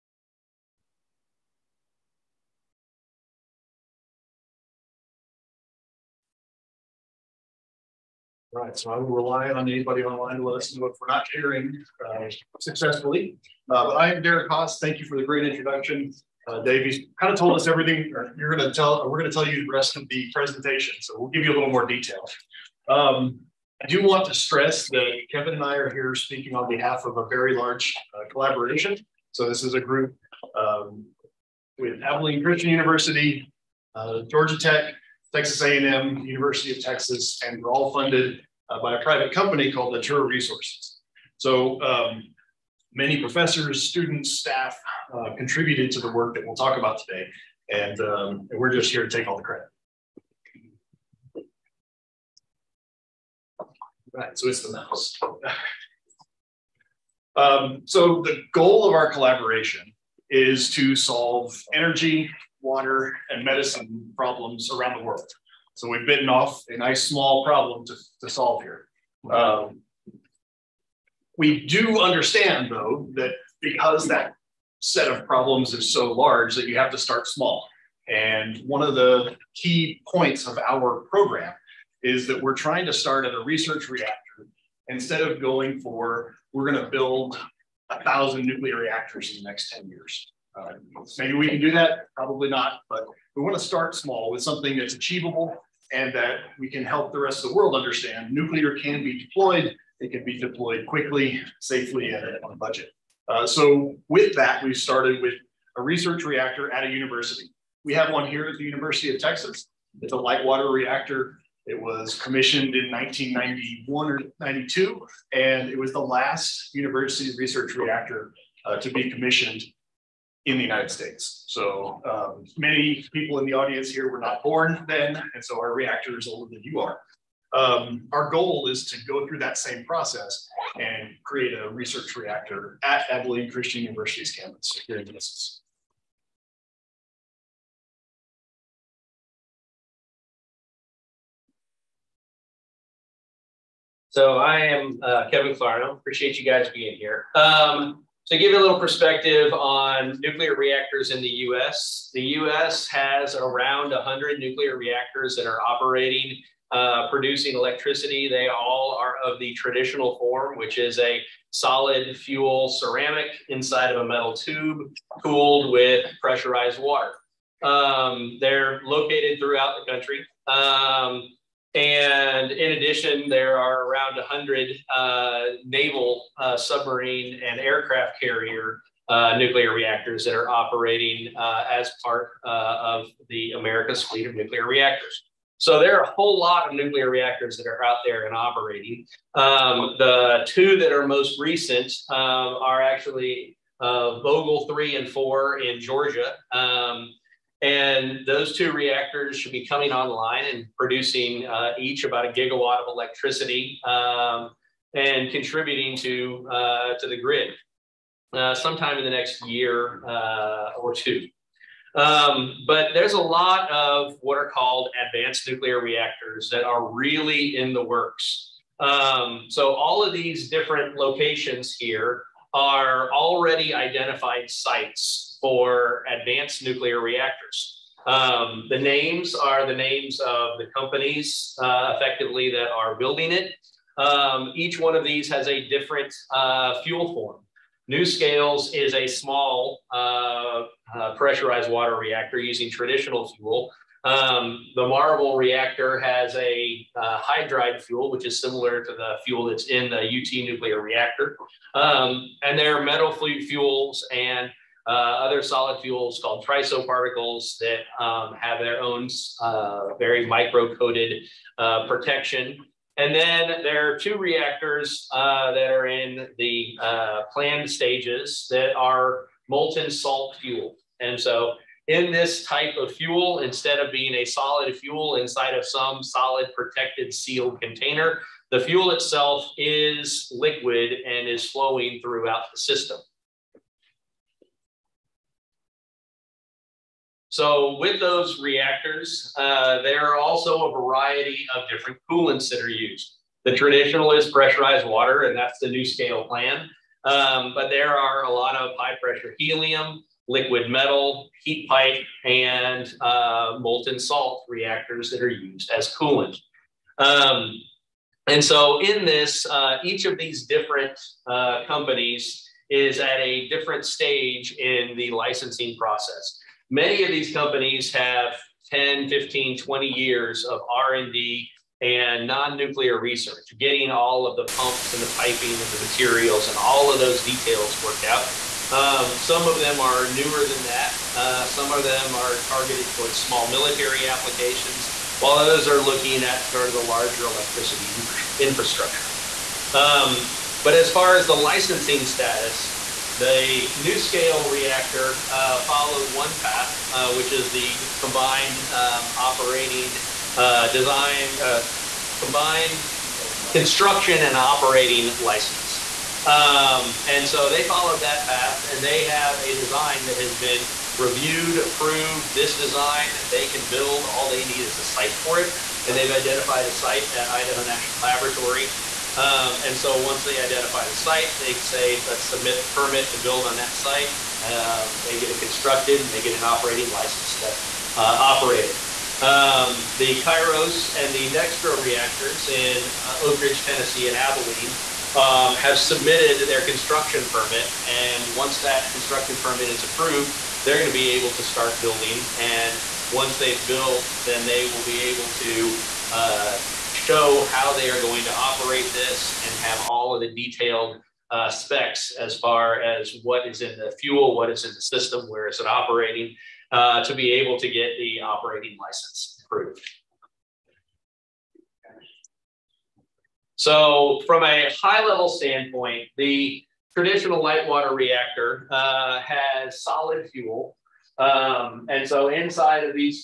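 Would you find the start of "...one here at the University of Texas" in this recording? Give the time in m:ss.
1:48.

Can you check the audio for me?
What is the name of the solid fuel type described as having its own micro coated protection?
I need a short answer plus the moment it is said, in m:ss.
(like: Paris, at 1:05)
triso particles, at 4:16.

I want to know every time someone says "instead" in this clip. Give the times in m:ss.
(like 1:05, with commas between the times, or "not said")
1:24, 4:33.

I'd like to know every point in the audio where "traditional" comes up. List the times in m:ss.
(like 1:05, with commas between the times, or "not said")
2:39, 4:02, 4:53, 6:56.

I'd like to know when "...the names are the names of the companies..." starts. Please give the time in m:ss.
3:48.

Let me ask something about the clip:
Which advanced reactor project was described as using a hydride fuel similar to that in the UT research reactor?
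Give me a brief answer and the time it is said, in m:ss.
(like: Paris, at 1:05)
Marvel, at 4:04.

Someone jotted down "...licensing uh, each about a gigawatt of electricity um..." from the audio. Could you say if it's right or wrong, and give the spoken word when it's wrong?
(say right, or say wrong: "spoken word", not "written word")
wrong: "producing", not "licensing".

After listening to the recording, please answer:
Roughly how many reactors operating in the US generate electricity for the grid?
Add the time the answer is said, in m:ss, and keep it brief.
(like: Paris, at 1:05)
100, at 2:33.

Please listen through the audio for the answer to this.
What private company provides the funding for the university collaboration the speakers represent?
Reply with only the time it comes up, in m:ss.
0:39.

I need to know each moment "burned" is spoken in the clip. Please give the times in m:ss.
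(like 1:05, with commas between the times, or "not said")
not said.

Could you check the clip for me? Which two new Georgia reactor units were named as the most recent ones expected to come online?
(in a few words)
Vogtle 3 and 4.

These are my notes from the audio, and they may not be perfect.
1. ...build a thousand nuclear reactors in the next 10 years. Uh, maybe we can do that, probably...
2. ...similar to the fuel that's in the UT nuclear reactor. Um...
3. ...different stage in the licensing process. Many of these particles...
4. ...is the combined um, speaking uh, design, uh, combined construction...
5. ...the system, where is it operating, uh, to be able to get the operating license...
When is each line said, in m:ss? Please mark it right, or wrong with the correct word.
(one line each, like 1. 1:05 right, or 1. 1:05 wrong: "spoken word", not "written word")
1. 1:26 right
2. 4:08 right
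3. 5:13 wrong: "companies", not "particles"
4. 5:47 wrong: "operating", not "speaking"
5. 6:44 right.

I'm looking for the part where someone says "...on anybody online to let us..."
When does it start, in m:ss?
0:09.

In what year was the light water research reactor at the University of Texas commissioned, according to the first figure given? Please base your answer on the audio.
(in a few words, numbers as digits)
1991.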